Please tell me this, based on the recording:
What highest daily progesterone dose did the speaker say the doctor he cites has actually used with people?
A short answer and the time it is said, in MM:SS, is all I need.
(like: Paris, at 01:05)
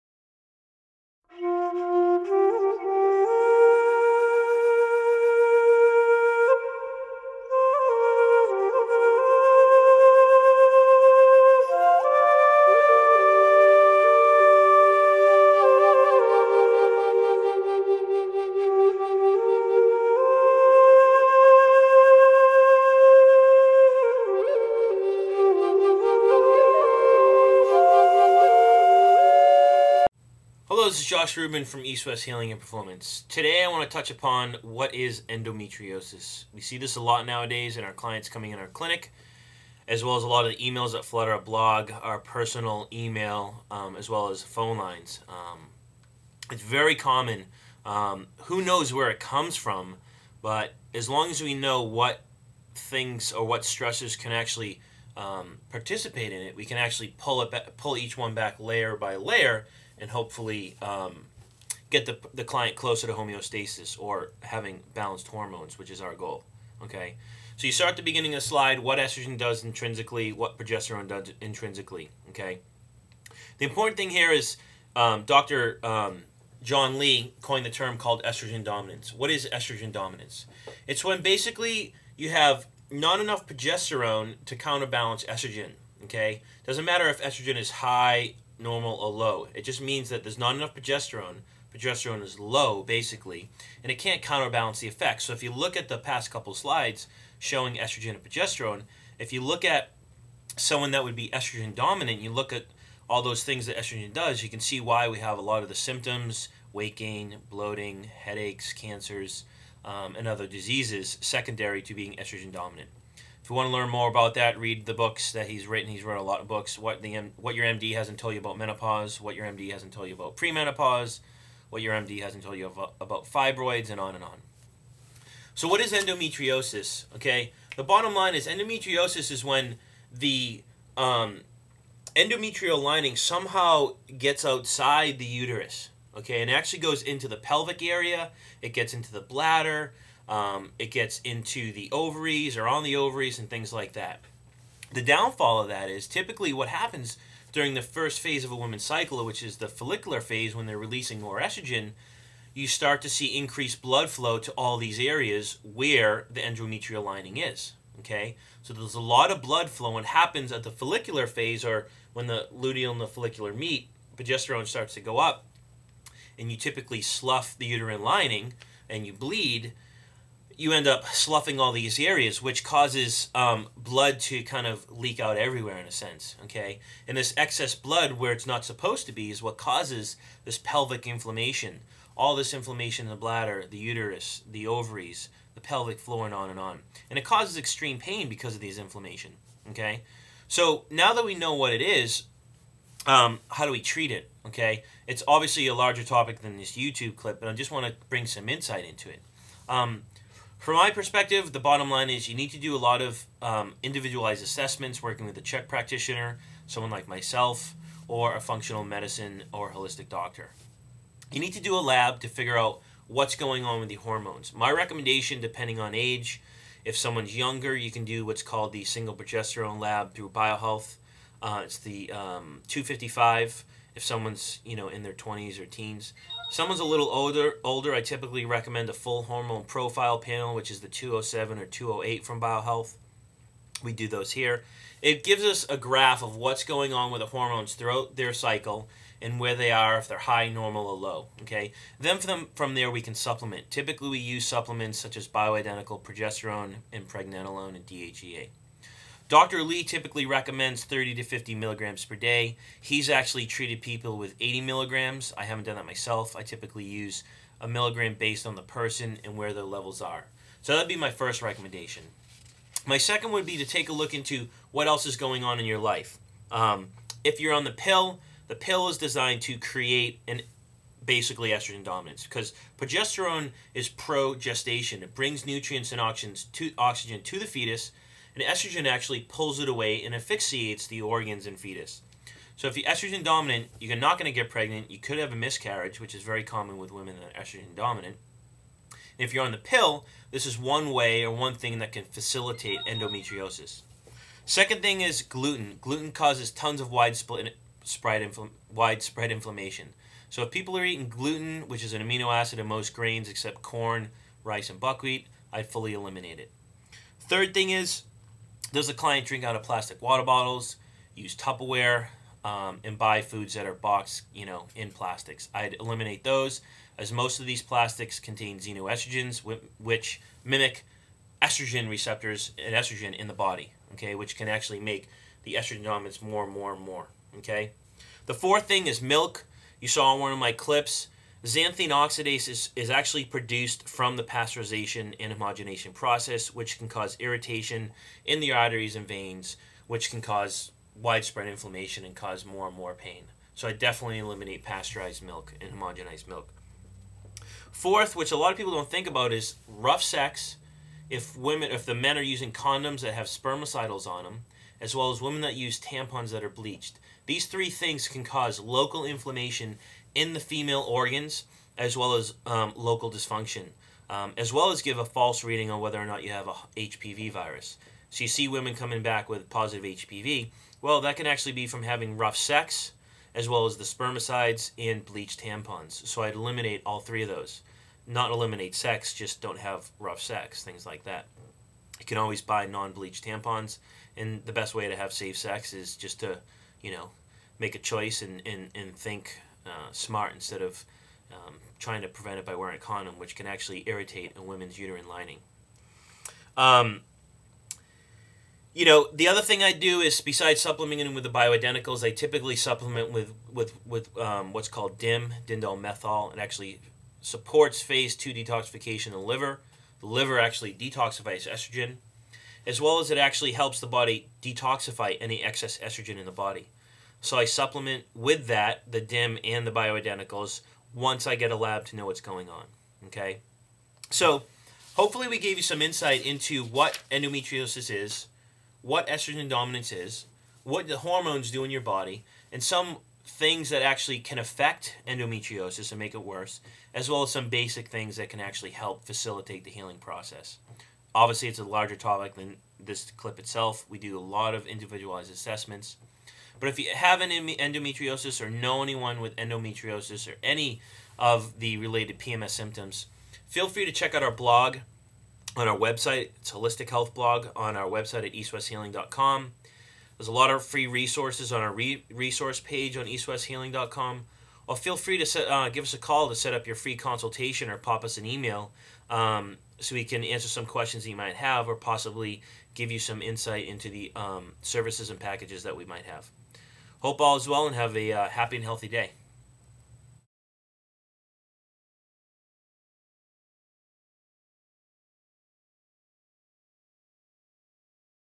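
80 milligrams, at 04:14.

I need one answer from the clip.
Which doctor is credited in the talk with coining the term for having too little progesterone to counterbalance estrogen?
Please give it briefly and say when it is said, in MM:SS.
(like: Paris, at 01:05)
John Lee, at 01:16.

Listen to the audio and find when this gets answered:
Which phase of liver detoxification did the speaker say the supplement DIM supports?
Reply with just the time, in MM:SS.
06:47.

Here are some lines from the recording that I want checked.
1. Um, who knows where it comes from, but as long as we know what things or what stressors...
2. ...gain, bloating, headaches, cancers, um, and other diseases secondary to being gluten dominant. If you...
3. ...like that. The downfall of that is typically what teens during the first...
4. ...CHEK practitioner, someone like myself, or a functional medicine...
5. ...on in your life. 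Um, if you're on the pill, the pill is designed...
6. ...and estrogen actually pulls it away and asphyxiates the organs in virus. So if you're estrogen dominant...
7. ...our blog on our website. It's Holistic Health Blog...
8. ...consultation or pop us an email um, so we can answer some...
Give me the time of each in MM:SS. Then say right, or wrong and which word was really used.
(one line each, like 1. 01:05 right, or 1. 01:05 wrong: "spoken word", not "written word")
1. 00:47 right
2. 01:46 wrong: "estrogen", not "gluten"
3. 02:23 wrong: "happens", not "teens"
4. 03:25 right
5. 04:25 right
6. 04:38 wrong: "fetus", not "virus"
7. 07:34 right
8. 07:46 right.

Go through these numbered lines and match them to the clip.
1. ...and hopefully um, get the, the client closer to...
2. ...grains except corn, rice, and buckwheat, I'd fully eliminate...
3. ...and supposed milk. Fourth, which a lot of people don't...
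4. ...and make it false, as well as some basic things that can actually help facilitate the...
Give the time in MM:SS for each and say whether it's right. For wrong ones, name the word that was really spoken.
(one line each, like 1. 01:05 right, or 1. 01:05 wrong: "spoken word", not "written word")
1. 01:00 right
2. 05:02 right
3. 05:45 wrong: "homogenized", not "supposed"
4. 07:15 wrong: "worse", not "false".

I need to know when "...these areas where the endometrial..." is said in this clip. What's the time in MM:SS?
02:34.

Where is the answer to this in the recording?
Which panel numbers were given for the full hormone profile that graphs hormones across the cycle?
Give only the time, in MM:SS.
03:50.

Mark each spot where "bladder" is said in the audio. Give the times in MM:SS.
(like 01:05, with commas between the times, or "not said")
02:19, 03:03.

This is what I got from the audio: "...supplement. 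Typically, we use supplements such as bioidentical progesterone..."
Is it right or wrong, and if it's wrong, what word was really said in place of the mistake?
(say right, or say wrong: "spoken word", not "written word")
right.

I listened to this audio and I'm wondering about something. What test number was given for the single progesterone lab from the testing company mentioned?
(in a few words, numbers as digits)
255.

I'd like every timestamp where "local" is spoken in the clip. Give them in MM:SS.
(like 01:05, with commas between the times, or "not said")
05:58, 06:02.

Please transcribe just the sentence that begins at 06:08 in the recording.
So you see women coming back with positive HPV.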